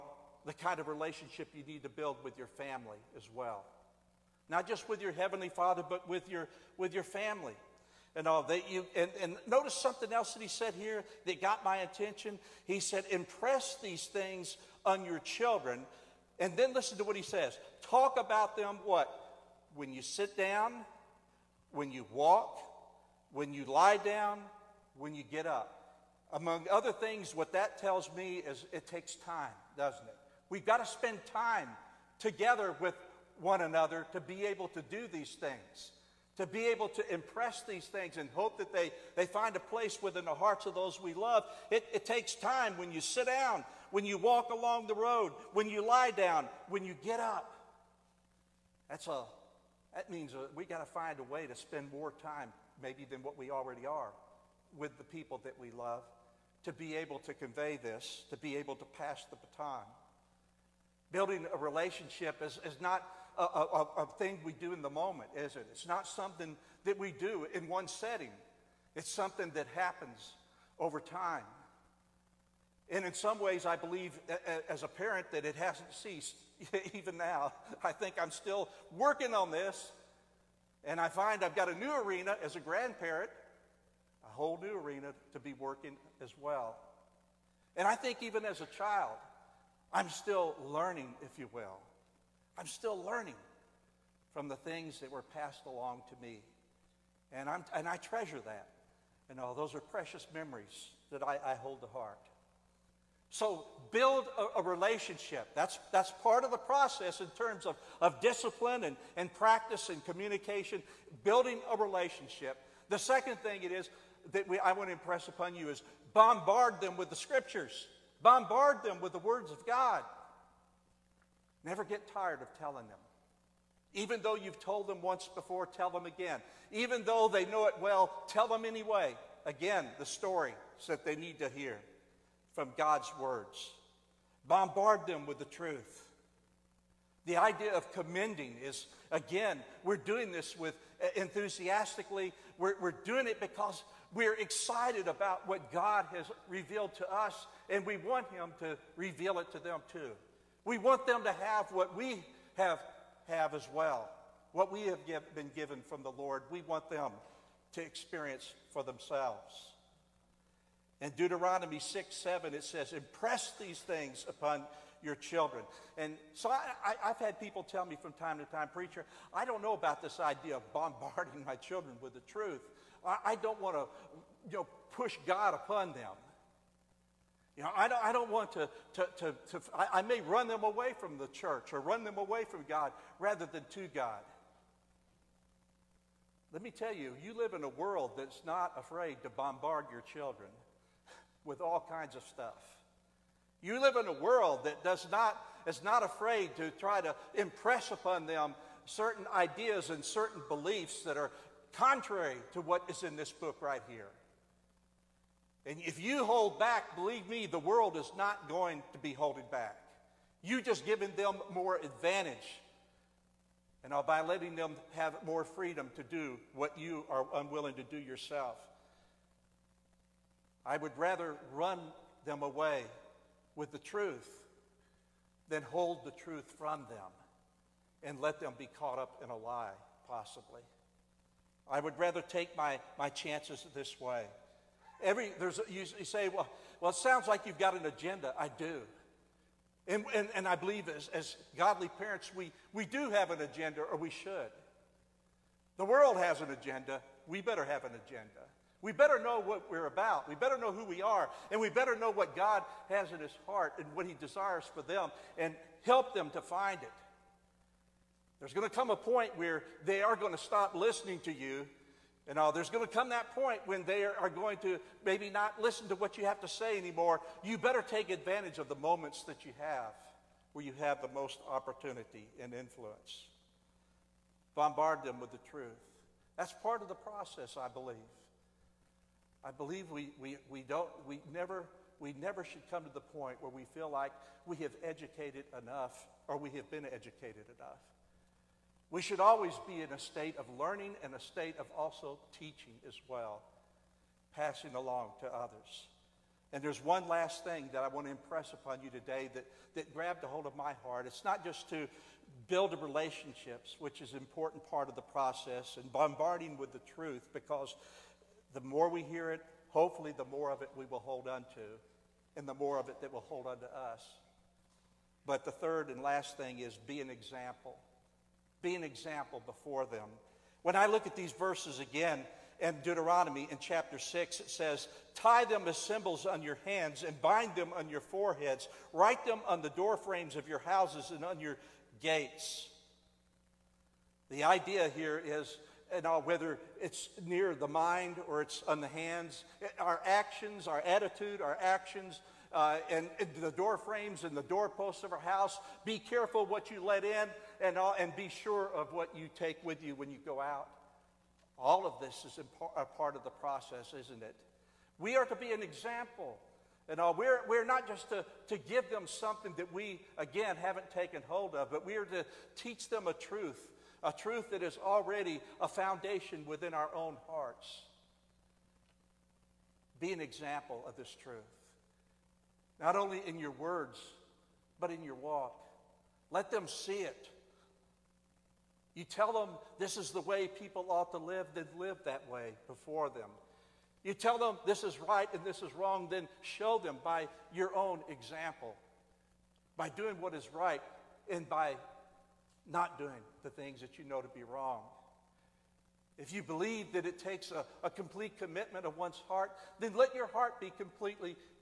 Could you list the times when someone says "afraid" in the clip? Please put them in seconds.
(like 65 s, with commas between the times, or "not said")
188 s, 196 s.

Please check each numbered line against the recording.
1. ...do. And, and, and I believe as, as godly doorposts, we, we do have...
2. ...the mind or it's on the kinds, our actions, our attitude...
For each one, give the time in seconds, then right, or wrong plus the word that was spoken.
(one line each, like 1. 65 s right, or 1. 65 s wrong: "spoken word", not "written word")
1. 238 s wrong: "parents", not "doorposts"
2. 337 s wrong: "hands", not "kinds".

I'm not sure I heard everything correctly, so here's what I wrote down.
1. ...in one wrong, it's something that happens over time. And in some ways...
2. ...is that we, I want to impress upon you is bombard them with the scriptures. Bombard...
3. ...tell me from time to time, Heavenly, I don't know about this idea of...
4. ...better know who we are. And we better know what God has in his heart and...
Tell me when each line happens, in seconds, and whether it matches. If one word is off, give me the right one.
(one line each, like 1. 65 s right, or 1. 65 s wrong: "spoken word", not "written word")
1. 67 s wrong: "setting", not "wrong"
2. 113 s right
3. 167 s wrong: "Preacher", not "Heavenly"
4. 250 s right.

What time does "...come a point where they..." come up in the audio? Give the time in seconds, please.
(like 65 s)
258 s.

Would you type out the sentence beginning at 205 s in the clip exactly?
And if you hold back, believe me, the world is not going to be holding back.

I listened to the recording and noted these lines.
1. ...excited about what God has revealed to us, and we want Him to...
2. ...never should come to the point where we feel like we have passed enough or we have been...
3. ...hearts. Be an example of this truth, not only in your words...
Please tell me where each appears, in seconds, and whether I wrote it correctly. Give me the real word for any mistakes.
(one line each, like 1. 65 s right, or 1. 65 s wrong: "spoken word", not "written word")
1. 144 s right
2. 282 s wrong: "educated", not "passed"
3. 367 s right.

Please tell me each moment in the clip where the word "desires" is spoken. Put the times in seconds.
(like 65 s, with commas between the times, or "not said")
254 s.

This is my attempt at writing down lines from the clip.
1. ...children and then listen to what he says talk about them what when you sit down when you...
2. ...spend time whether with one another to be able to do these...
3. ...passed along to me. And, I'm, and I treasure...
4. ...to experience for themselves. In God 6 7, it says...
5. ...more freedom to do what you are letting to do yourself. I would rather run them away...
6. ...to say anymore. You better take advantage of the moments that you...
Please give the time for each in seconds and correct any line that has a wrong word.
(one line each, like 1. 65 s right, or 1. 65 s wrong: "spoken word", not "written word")
1. 15 s right
2. 30 s wrong: "together", not "whether"
3. 95 s right
4. 157 s wrong: "Deuteronomy", not "God"
5. 215 s wrong: "unwilling", not "letting"
6. 266 s right.